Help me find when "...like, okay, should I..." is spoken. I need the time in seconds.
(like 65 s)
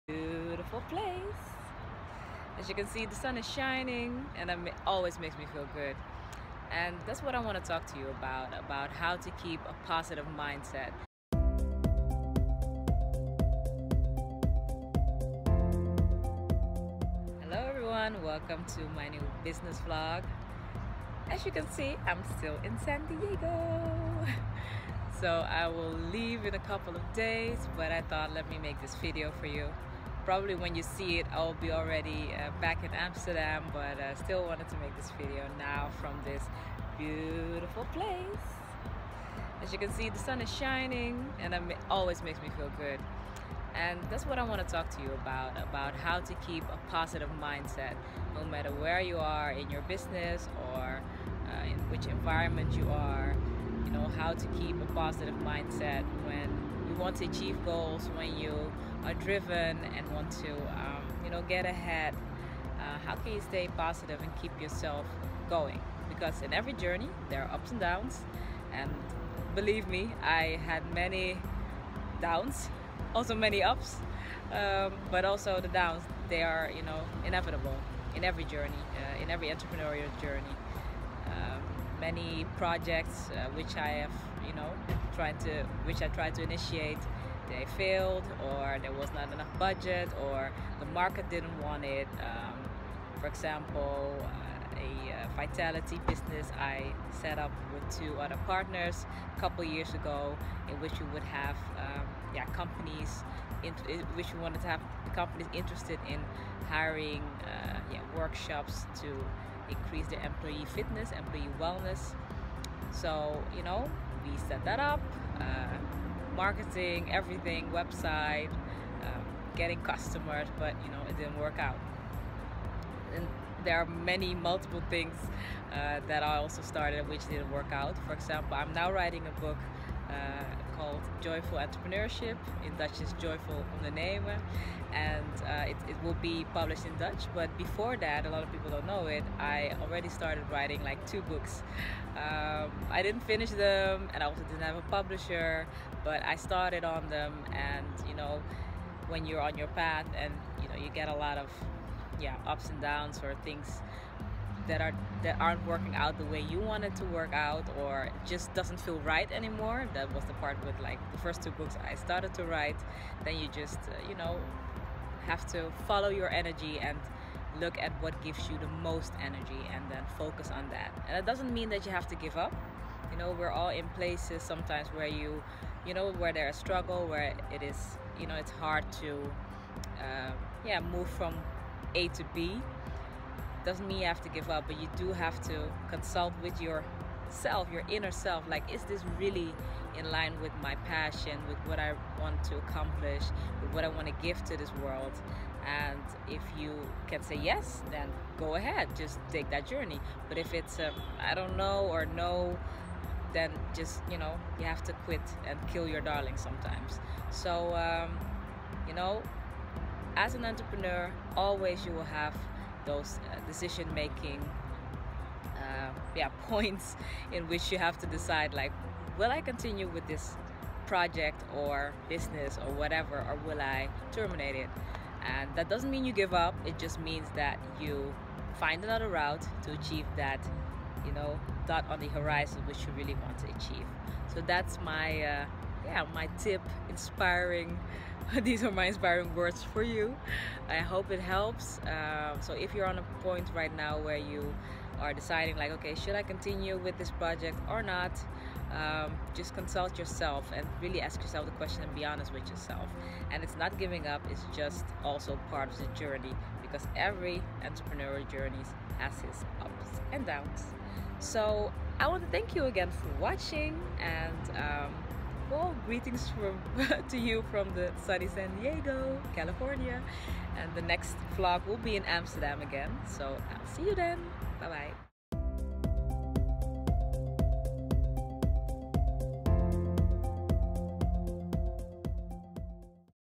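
245 s.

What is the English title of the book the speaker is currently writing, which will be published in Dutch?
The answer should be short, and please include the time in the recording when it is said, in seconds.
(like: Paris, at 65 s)
Joyful Entrepreneurship, at 131 s.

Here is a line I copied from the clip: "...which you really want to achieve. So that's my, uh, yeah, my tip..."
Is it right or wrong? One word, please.
right.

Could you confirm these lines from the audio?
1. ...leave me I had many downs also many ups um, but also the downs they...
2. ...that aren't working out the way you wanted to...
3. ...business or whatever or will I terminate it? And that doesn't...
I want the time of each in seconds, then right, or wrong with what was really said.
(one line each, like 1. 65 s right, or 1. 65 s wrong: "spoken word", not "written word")
1. 69 s wrong: "believe", not "leave"
2. 155 s right
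3. 222 s right.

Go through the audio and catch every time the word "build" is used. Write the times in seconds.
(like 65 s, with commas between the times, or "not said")
not said.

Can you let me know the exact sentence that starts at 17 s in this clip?
Hello everyone, welcome to my new business vlog.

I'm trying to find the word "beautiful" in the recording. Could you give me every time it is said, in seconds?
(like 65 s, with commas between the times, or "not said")
0 s, 36 s.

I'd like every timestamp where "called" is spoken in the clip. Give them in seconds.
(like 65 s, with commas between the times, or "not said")
130 s.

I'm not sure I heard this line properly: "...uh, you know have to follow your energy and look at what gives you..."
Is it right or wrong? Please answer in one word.
right.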